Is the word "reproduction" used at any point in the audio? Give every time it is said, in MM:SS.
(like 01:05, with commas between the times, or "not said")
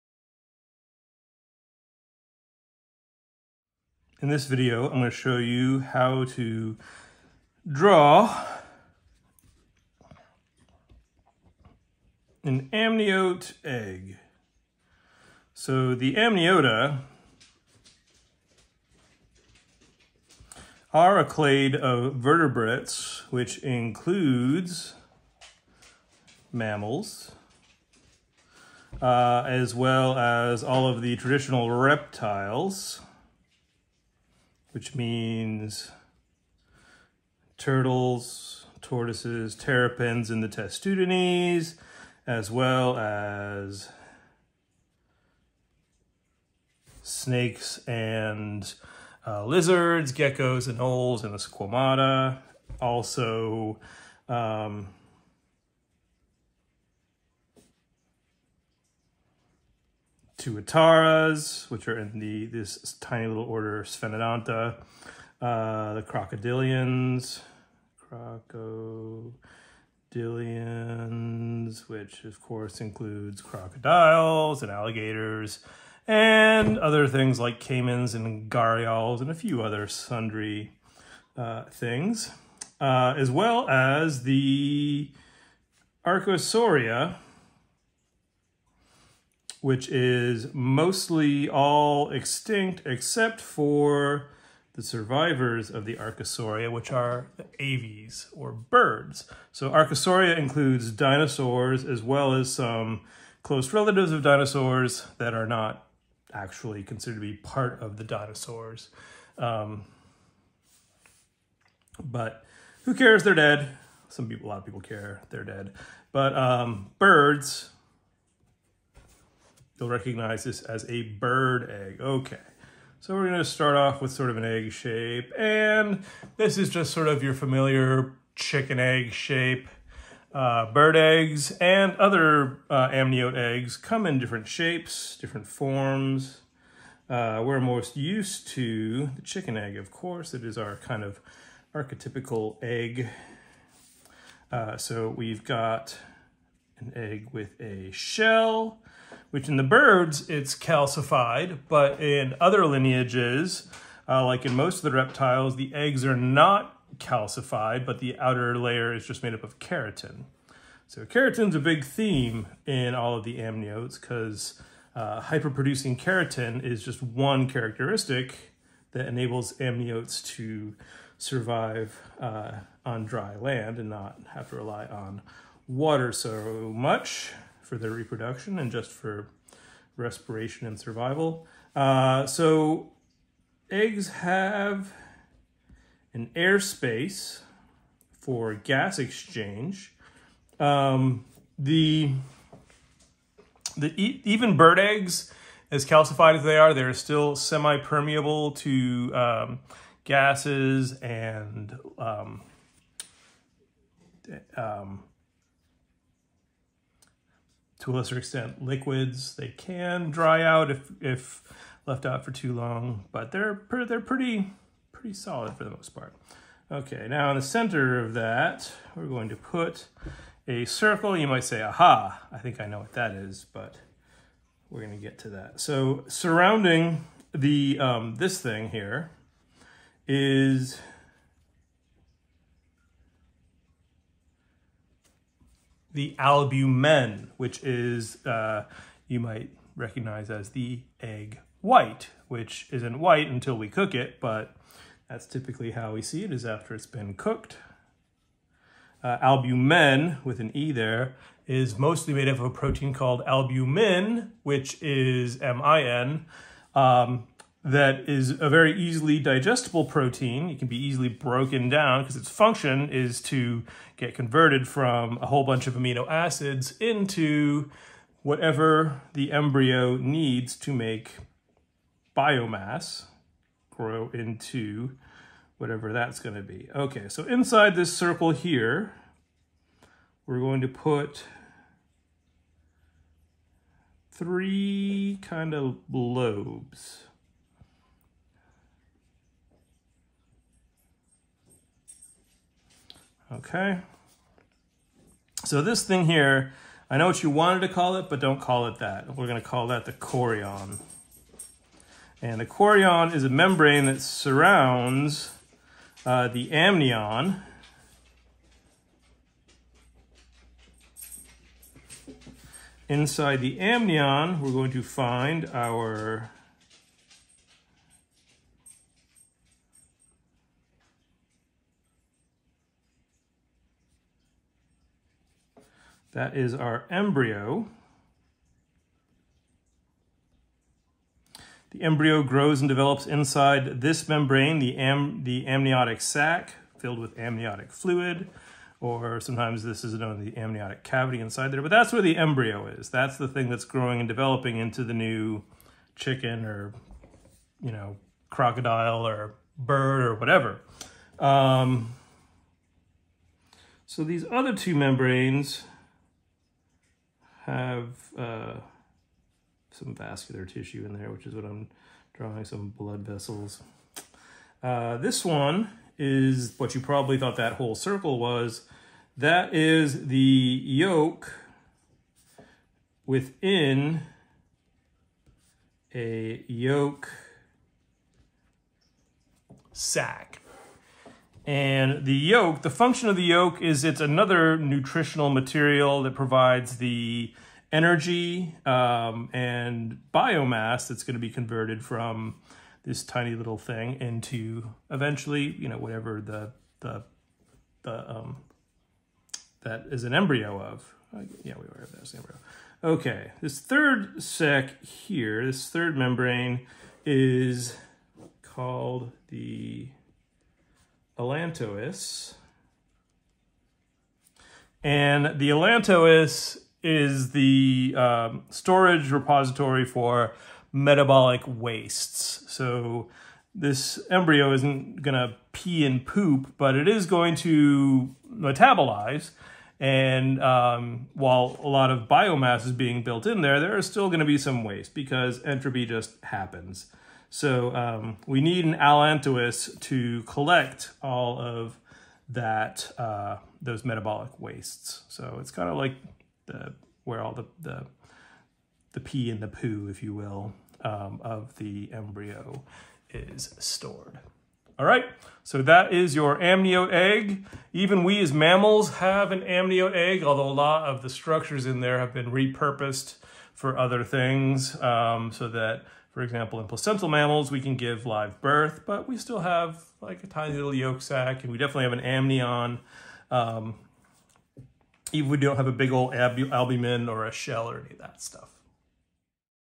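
02:57.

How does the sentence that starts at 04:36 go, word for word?
Okay, so inside this circle here, we're going to put three kind of lobes.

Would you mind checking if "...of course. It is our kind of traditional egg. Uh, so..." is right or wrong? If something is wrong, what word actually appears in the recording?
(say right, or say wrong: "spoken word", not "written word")
wrong: "archetypical", not "traditional".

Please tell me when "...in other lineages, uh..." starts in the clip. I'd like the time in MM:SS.
02:32.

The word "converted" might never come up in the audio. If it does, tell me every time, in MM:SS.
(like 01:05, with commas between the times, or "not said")
04:24, 06:31.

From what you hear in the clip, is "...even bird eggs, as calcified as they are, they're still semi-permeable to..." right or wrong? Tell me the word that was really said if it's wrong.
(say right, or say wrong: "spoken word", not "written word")
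right.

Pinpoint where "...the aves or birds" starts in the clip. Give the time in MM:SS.
01:37.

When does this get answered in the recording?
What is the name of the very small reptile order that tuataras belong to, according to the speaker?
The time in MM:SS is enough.
01:03.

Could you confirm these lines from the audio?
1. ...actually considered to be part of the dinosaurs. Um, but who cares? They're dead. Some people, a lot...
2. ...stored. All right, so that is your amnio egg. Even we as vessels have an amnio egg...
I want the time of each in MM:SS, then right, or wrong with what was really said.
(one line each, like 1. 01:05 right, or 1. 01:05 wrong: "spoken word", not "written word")
1. 01:46 right
2. 07:33 wrong: "mammals", not "vessels".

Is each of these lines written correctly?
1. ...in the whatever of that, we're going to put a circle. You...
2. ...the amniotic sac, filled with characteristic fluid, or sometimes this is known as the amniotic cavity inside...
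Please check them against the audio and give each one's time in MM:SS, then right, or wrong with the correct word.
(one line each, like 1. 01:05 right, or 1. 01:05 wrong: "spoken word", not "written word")
1. 03:37 wrong: "center", not "whatever"
2. 05:35 wrong: "amniotic", not "characteristic".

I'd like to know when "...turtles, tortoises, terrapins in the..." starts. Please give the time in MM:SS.
00:37.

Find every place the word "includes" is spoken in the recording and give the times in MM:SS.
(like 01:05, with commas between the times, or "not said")
00:23, 01:12, 01:40.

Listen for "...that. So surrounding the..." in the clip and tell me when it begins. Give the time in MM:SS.
03:45.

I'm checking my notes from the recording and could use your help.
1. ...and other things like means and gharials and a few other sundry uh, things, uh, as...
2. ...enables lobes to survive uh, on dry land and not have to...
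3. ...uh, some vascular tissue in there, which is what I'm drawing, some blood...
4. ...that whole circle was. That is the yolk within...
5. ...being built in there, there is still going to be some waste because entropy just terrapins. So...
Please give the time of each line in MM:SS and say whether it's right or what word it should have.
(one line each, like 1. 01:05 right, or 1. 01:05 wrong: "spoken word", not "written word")
1. 01:16 wrong: "caimans", not "means"
2. 02:49 wrong: "amniotes", not "lobes"
3. 05:58 right
4. 06:07 right
5. 07:12 wrong: "happens", not "terrapins".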